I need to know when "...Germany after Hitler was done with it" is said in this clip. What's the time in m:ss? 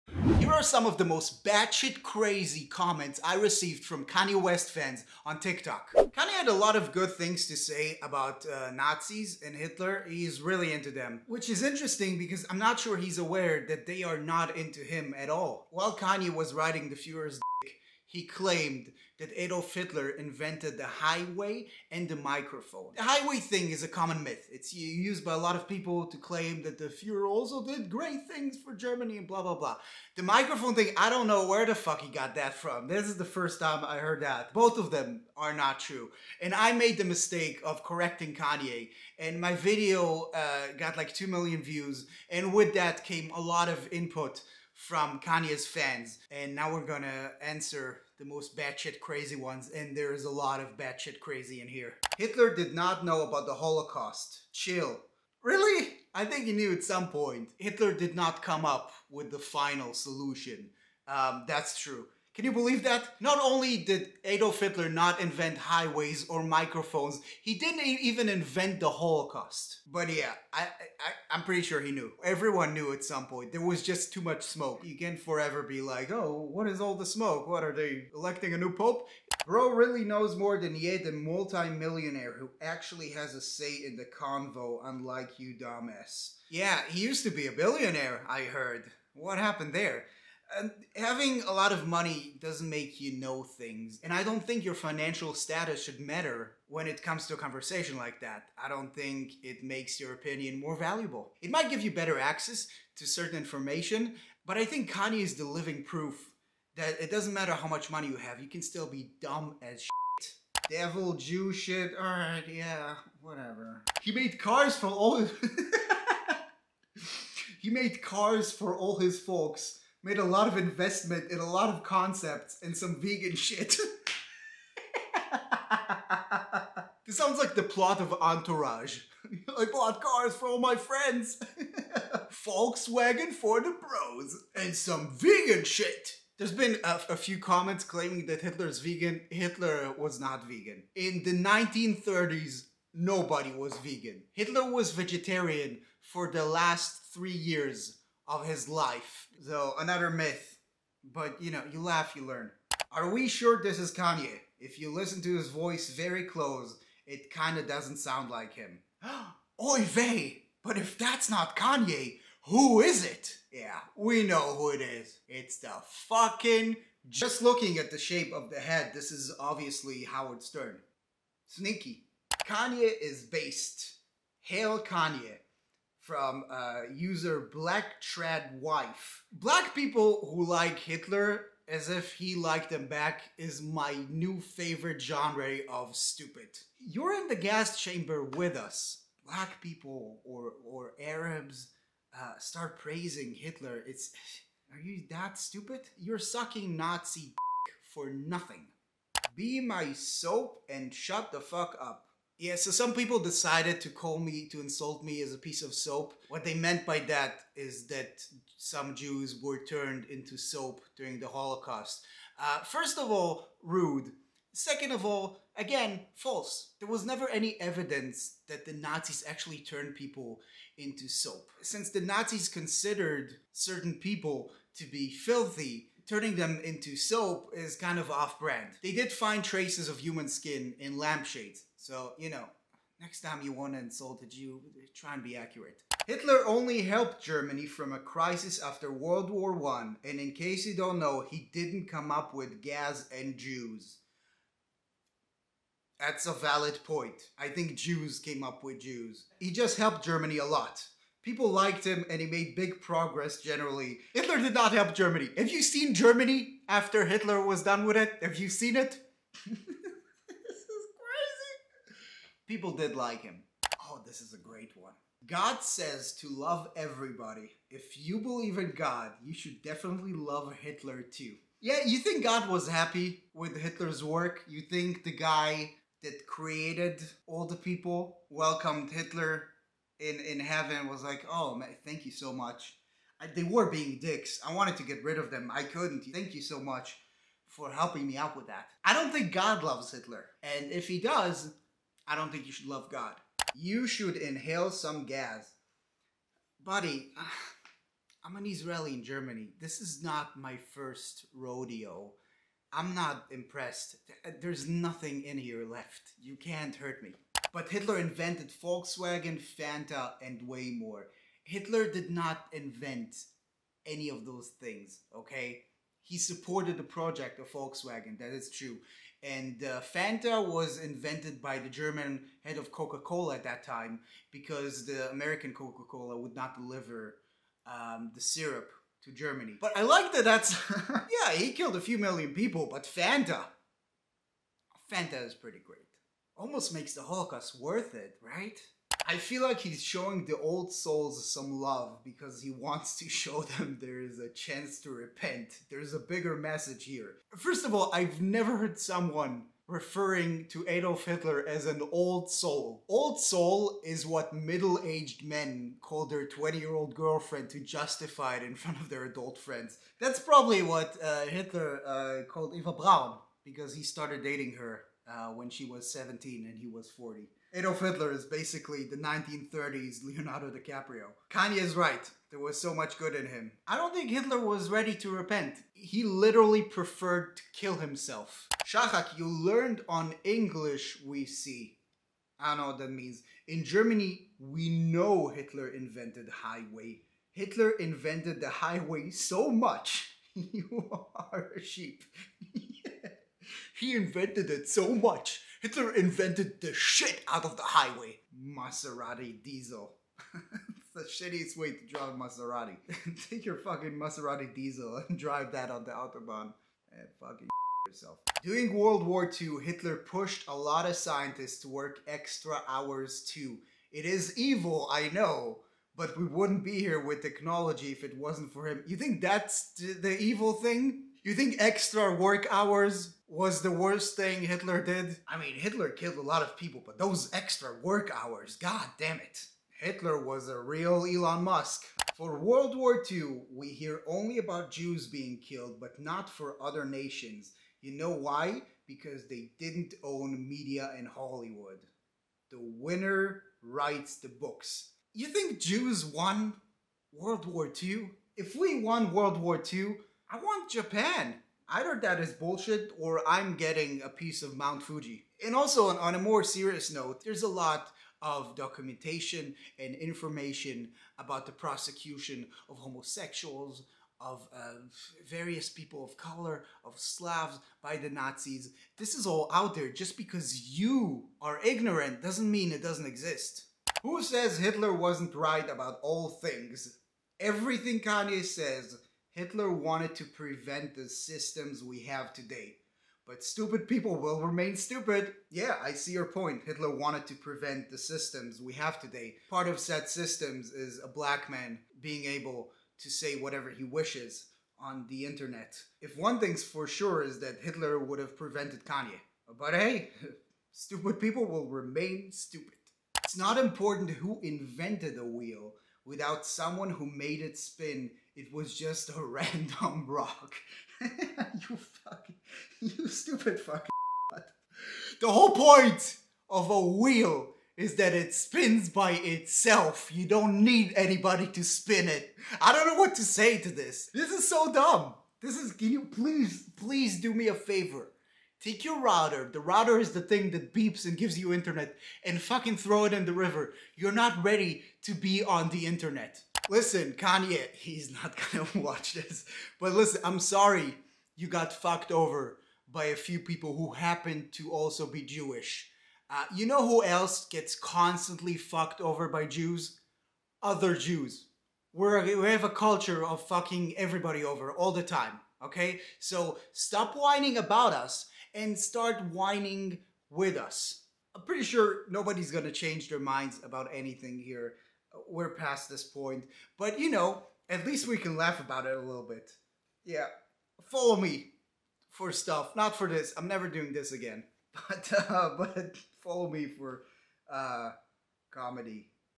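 4:15.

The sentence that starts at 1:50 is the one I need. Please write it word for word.
Devil, Jew shit, alright, yeah, whatever.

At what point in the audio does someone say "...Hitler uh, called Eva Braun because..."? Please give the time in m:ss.
6:01.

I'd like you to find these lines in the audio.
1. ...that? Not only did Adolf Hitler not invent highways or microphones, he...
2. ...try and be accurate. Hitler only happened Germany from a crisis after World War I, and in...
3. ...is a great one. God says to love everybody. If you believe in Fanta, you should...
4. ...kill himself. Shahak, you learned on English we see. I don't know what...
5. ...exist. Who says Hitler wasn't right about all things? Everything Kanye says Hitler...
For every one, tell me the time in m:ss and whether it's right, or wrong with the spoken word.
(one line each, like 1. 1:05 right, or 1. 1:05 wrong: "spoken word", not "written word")
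1. 1:02 right
2. 3:54 wrong: "helped", not "happened"
3. 4:24 wrong: "God", not "Fanta"
4. 6:17 right
5. 7:53 right.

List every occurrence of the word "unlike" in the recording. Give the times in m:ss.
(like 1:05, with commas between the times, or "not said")
1:24.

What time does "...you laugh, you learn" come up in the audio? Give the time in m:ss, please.
2:31.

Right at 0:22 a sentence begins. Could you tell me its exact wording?
The highway thing is a common myth.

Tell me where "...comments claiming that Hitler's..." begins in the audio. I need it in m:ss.
2:17.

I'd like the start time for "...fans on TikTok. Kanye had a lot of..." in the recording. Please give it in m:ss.
0:04.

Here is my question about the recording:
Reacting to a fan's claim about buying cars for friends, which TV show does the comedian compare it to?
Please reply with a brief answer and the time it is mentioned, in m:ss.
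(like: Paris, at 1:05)
Entourage, at 2:08.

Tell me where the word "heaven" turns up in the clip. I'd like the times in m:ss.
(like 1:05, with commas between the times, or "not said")
4:40.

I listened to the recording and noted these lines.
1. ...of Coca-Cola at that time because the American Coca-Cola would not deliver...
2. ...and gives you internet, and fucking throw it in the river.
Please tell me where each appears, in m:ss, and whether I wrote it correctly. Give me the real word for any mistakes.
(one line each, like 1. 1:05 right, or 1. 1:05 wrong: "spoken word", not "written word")
1. 5:22 right
2. 8:51 right.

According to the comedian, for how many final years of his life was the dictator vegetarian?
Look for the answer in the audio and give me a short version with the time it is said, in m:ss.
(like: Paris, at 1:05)
3, at 2:27.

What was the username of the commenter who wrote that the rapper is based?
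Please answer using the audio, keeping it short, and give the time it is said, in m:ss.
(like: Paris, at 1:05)
Black Trad Wife, at 2:57.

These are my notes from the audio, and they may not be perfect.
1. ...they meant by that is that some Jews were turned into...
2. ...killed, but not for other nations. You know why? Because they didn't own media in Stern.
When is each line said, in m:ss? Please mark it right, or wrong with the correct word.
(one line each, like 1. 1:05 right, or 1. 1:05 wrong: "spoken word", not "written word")
1. 3:26 right
2. 7:15 wrong: "Hollywood", not "Stern".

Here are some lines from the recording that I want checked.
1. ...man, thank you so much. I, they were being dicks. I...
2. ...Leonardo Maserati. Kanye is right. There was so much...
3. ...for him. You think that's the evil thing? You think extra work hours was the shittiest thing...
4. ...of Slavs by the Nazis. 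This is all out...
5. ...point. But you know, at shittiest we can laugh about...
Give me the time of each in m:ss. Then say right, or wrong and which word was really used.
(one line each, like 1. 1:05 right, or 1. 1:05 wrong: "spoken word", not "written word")
1. 4:41 right
2. 6:10 wrong: "DiCaprio", not "Maserati"
3. 6:58 wrong: "worst", not "shittiest"
4. 7:46 right
5. 9:26 wrong: "least", not "shittiest".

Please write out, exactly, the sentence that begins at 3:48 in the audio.
They did find traces of human skin in lampshades.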